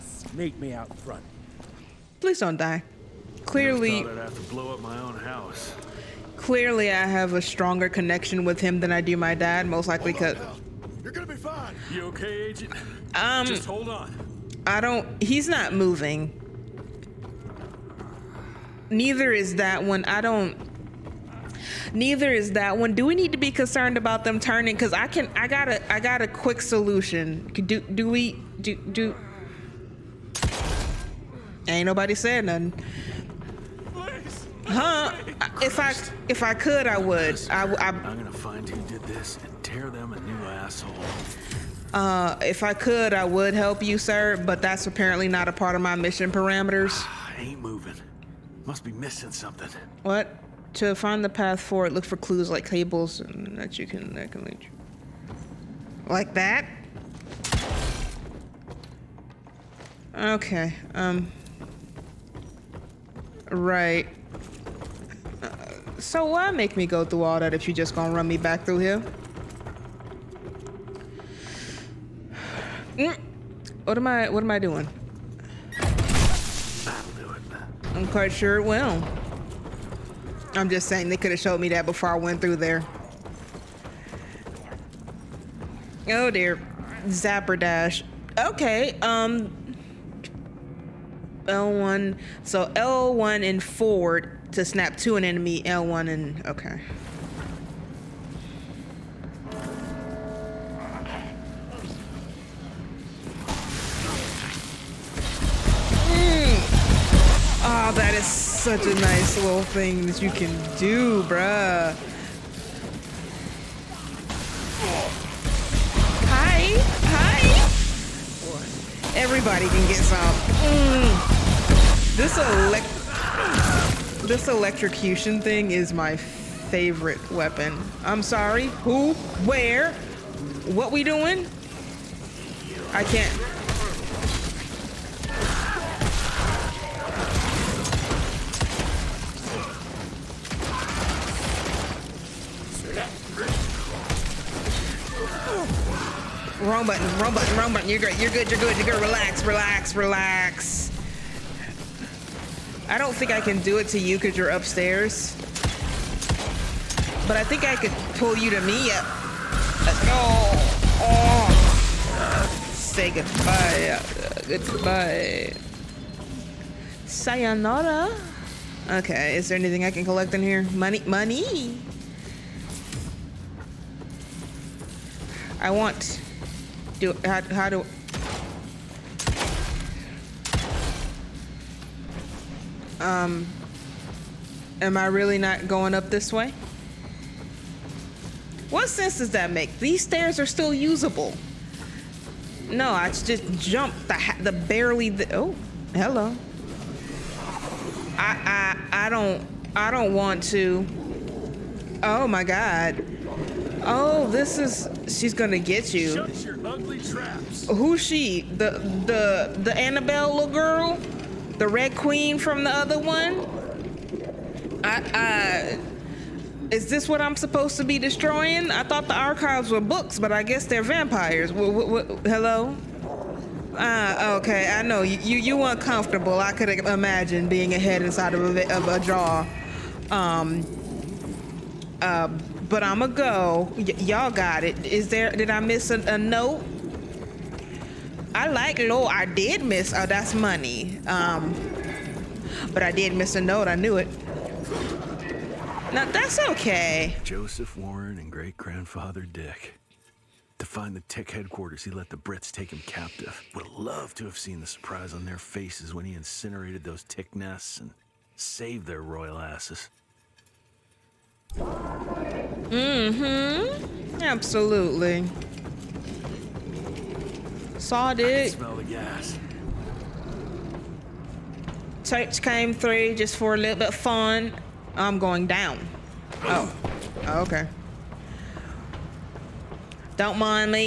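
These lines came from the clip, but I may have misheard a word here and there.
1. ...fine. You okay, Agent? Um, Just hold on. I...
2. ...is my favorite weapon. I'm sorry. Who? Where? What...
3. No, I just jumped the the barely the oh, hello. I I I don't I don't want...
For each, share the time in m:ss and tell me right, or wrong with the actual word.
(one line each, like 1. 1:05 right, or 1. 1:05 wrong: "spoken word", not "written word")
1. 0:11 right
2. 2:05 right
3. 3:12 right.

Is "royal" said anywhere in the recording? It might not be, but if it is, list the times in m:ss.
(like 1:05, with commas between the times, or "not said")
4:19.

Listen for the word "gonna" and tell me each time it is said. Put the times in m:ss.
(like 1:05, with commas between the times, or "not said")
0:11, 0:38, 1:07, 3:25.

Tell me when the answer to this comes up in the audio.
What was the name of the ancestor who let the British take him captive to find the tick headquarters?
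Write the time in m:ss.
4:07.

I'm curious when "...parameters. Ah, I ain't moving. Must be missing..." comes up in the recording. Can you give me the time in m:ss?
0:46.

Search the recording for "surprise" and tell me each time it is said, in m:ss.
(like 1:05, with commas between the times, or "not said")
4:14.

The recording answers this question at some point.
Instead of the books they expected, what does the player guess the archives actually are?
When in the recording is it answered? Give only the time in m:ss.
3:40.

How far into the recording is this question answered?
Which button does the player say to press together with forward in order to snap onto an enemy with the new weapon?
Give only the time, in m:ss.
1:35.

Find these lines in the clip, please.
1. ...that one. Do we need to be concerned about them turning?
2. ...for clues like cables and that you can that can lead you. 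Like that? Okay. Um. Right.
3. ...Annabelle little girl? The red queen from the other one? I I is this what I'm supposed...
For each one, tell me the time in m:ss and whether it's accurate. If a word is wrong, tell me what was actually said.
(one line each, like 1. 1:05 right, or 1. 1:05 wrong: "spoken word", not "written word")
1. 0:22 right
2. 0:52 right
3. 3:29 right.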